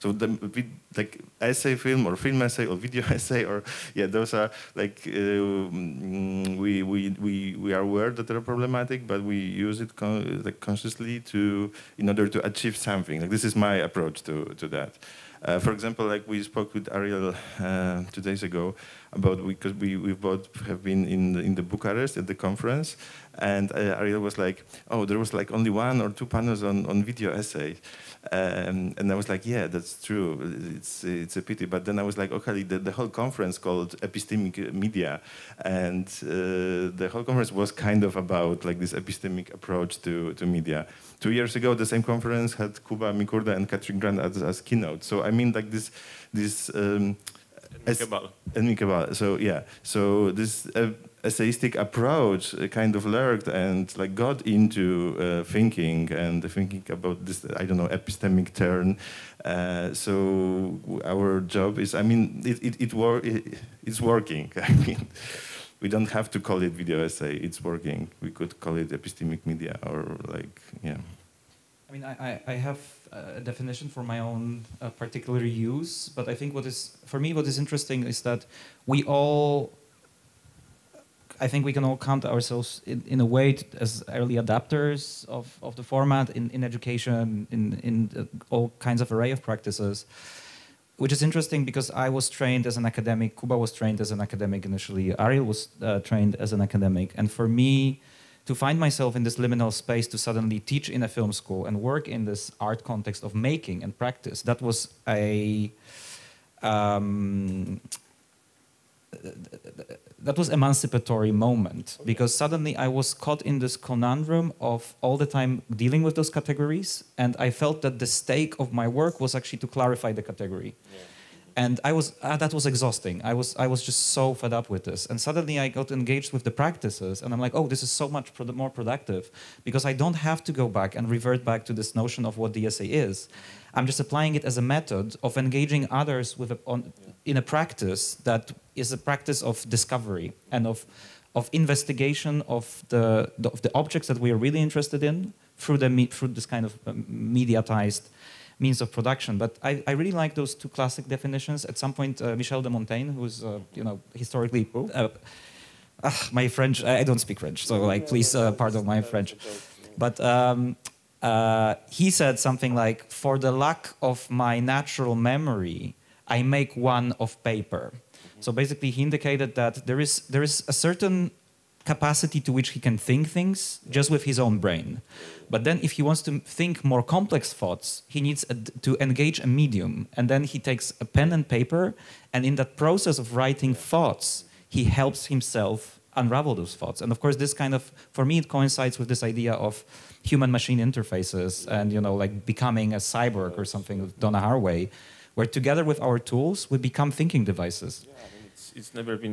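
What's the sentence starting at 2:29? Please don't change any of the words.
But I, I really like those two classic definitions.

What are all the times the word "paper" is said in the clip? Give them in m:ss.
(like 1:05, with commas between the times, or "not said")
2:47, 3:01.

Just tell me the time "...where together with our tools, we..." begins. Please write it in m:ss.
3:15.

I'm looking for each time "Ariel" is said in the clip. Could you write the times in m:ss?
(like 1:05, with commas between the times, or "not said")
0:16, 0:23, 1:35.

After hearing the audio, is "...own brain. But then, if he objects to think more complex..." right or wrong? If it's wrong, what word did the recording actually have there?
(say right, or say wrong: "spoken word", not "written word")
wrong: "wants", not "objects".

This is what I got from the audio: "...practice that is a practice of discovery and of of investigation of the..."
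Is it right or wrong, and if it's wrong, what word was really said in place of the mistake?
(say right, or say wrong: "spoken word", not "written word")
right.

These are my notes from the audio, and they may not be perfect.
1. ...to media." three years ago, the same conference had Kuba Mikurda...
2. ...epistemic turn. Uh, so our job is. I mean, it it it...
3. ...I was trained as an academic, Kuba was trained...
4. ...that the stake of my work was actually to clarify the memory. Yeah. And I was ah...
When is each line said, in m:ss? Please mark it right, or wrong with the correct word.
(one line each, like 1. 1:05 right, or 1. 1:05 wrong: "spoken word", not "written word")
1. 0:40 wrong: "two", not "three"
2. 0:57 right
3. 1:31 right
4. 1:57 wrong: "category", not "memory".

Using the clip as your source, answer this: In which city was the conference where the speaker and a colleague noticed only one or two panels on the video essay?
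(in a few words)
Bucharest.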